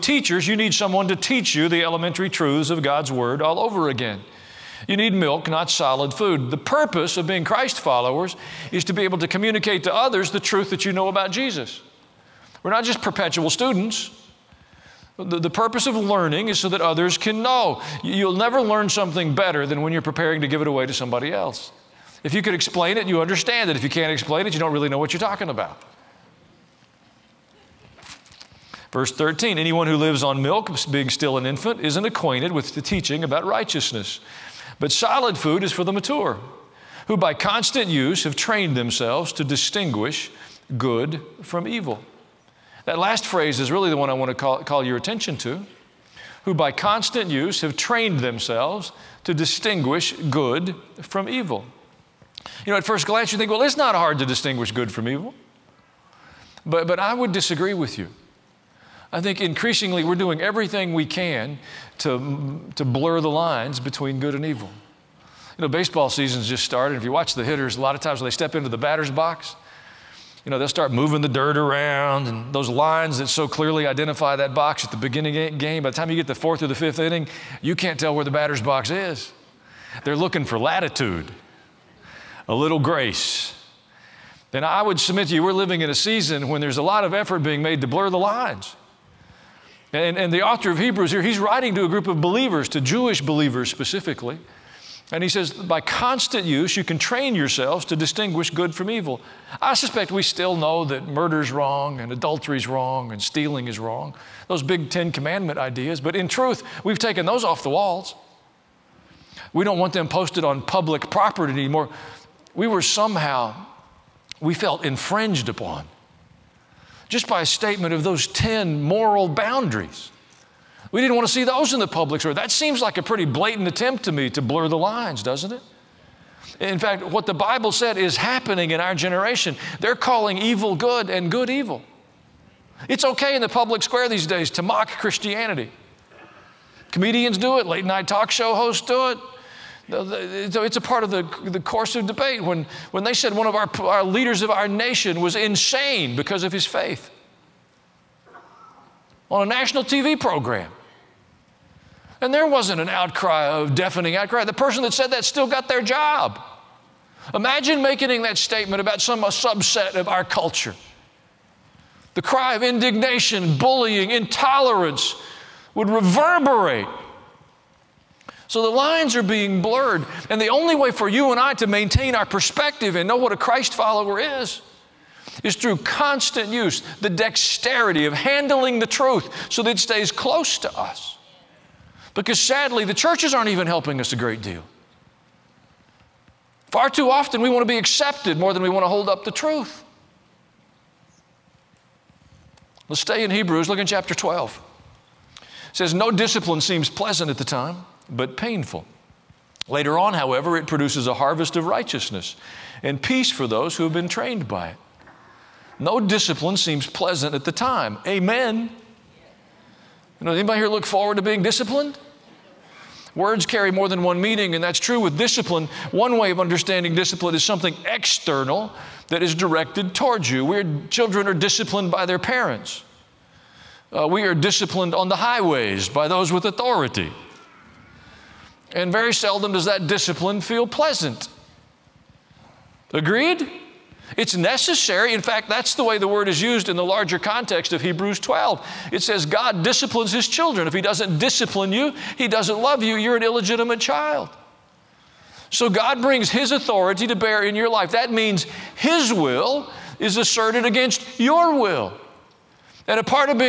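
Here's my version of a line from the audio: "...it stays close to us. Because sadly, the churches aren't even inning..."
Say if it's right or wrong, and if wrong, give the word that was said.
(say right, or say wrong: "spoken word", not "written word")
wrong: "helping", not "inning".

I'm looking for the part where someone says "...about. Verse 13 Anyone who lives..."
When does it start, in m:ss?
0:25.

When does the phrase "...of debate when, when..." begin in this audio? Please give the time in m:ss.
2:21.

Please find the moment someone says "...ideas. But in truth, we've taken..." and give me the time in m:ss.
1:45.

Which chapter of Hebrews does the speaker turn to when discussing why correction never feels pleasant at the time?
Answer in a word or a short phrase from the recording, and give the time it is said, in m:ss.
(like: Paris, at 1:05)
Chapter 12, at 3:13.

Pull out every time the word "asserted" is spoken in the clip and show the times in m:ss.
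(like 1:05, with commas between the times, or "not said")
4:10.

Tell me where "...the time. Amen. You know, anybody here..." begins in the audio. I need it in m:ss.
3:27.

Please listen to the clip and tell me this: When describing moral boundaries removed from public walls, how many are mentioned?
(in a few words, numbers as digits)
10.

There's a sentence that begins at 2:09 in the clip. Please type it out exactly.
They're calling evil good and good evil.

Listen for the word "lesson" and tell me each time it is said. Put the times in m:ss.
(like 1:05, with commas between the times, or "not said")
not said.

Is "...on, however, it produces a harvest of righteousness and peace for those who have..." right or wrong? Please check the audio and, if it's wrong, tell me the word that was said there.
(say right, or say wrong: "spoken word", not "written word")
right.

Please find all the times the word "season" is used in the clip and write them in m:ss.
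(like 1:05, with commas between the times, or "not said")
1:06, 1:25.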